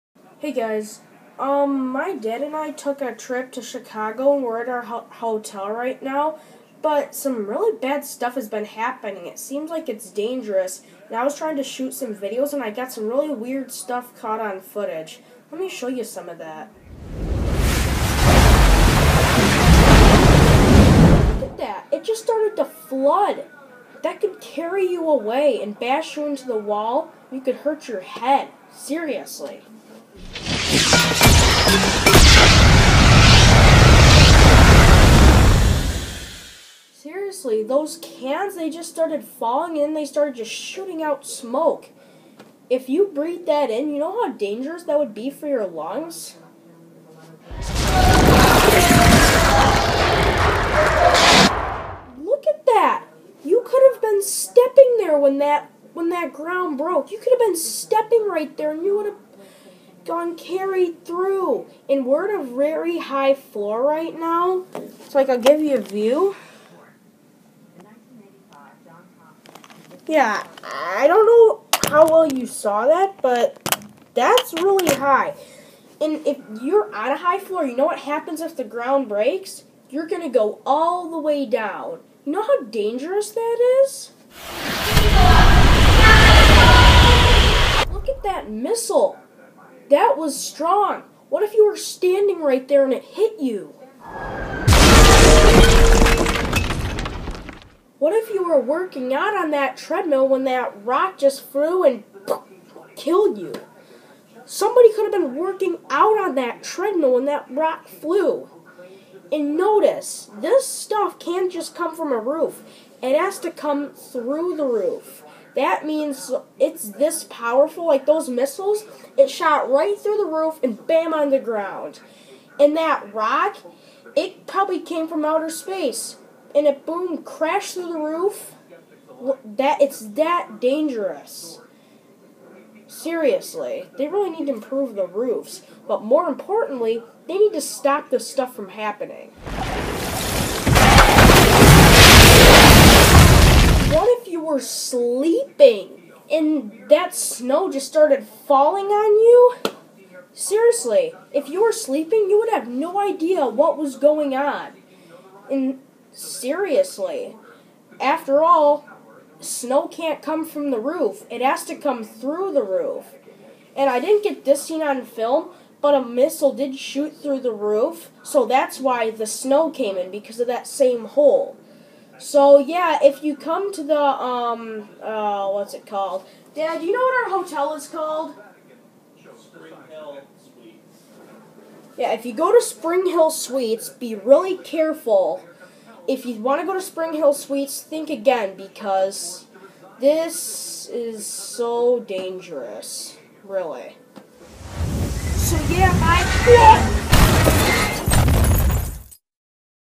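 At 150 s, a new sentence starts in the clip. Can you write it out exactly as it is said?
Seriously, if you were sleeping, you would have no idea what was going on.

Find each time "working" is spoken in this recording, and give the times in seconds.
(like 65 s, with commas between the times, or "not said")
98 s, 105 s.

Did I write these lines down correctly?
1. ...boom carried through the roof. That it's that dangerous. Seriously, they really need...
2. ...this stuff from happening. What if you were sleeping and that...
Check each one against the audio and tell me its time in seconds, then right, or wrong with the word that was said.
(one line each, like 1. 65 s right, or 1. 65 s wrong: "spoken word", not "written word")
1. 126 s wrong: "crashed", not "carried"
2. 138 s right.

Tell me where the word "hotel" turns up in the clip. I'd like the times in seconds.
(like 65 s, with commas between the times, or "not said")
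5 s, 177 s.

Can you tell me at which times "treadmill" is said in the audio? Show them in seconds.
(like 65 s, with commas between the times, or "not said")
99 s, 106 s.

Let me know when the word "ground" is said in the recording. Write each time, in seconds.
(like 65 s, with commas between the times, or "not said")
56 s, 78 s, 121 s.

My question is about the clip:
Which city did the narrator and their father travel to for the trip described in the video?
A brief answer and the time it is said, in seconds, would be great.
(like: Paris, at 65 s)
Chicago, at 3 s.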